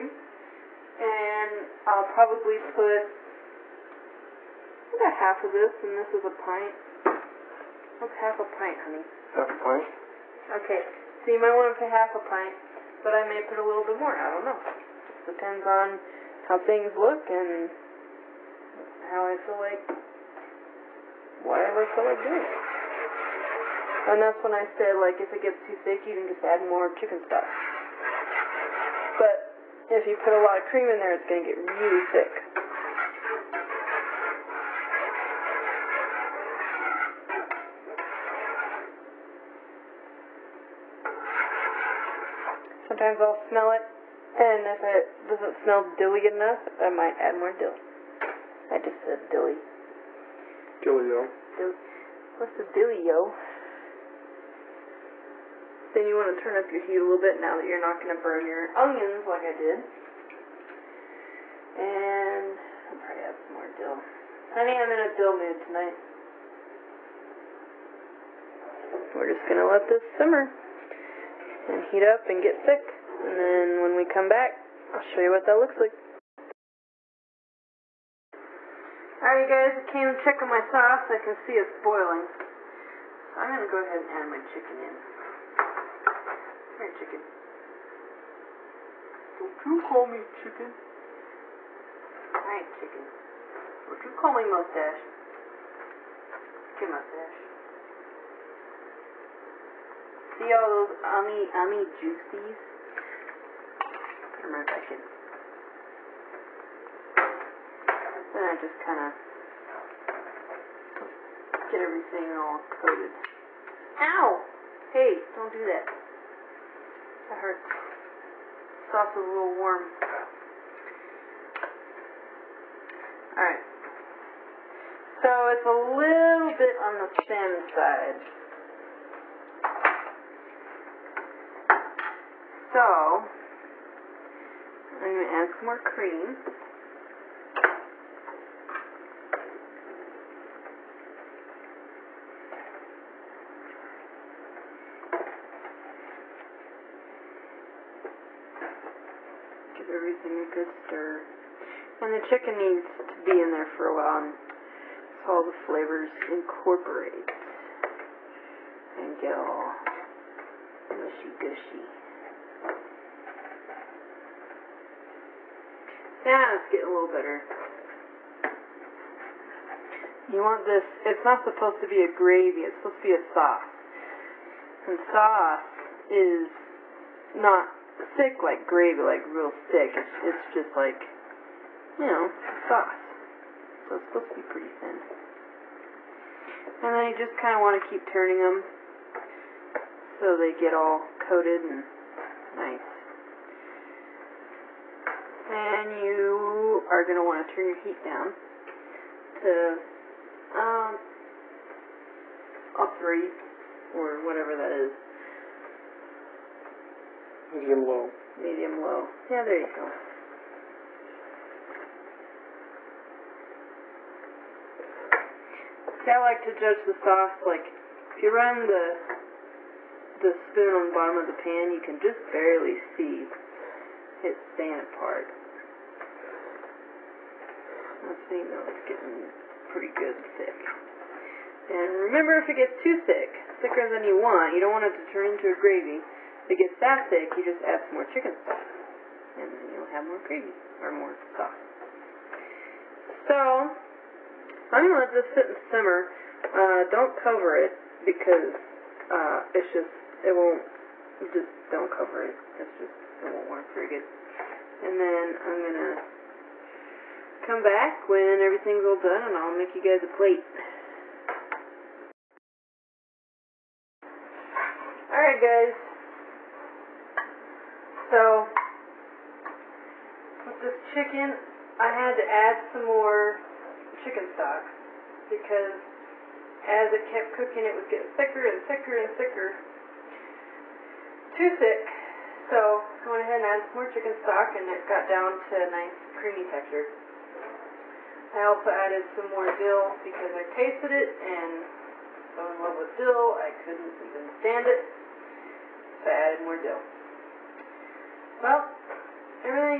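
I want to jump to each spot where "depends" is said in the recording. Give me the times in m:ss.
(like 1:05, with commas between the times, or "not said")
0:15.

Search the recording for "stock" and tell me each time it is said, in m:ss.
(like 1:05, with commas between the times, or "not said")
3:58, 4:34, 4:44.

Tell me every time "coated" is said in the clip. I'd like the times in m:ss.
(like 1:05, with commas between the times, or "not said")
1:52, 3:11.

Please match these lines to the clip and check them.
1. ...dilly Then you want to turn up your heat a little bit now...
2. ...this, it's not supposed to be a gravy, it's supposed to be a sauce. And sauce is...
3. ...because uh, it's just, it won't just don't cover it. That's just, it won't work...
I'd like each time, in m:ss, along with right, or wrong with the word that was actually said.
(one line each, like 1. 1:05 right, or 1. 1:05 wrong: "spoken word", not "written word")
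1. 0:52 right
2. 2:50 right
3. 4:08 right.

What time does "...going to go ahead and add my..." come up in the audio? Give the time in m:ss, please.
1:23.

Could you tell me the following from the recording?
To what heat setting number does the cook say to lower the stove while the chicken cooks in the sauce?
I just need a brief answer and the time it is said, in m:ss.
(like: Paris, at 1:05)
3, at 3:22.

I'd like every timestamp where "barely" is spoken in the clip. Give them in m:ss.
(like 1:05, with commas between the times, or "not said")
3:42.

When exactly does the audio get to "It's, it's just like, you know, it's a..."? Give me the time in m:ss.
2:59.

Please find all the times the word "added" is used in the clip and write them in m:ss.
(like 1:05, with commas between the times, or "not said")
4:43, 4:48, 4:56.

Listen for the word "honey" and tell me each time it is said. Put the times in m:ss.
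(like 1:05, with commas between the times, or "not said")
0:08, 1:04.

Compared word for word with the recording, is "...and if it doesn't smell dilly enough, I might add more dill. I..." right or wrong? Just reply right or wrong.
right.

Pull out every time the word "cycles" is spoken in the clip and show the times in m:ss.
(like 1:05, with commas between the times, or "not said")
not said.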